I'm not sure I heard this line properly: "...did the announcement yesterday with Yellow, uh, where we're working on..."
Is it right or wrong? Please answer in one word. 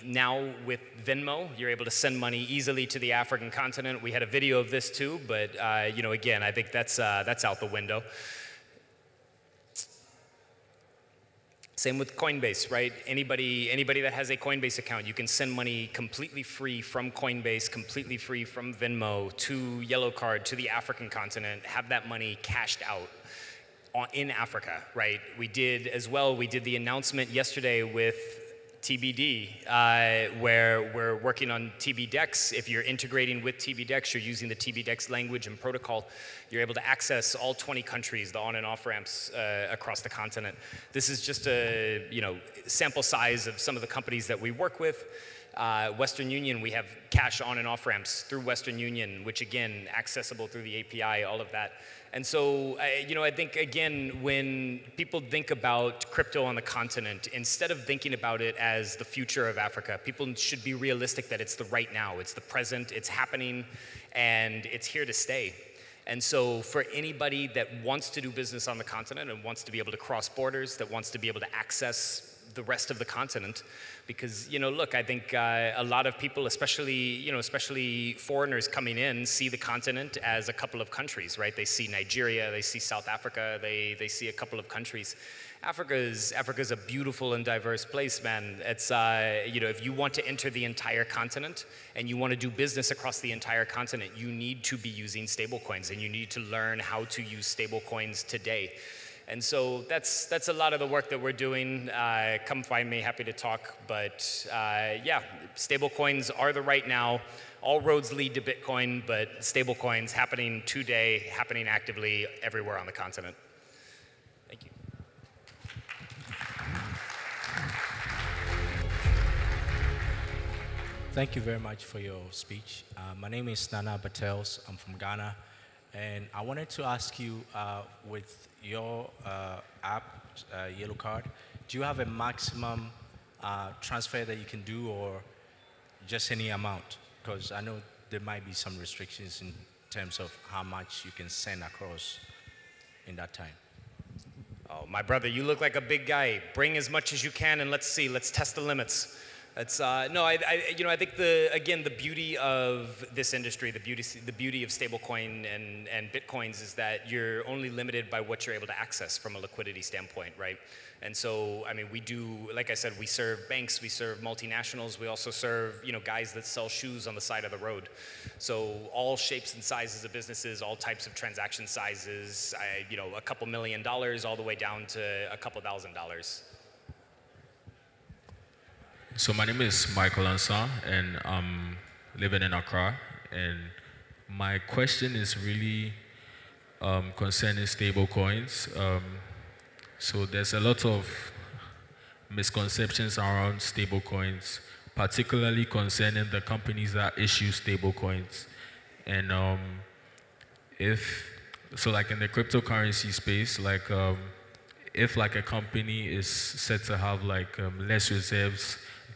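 wrong.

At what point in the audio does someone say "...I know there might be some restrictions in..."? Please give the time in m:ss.
2:17.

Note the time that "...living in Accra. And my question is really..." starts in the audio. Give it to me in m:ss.
3:02.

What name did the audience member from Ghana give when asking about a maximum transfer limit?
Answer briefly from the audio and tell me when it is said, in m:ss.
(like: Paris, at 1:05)
Nana Batels, at 2:03.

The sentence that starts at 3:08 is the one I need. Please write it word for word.
Um, so there's a lot of misconceptions around stable coins, particularly concerning the companies that issue stable coins.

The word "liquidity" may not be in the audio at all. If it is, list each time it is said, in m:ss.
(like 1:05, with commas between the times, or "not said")
2:39.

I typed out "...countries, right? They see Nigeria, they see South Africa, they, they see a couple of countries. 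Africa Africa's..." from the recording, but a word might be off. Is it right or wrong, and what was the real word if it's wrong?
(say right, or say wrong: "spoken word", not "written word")
right.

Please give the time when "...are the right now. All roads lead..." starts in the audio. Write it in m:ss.
1:46.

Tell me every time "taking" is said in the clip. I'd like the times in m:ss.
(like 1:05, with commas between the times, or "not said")
not said.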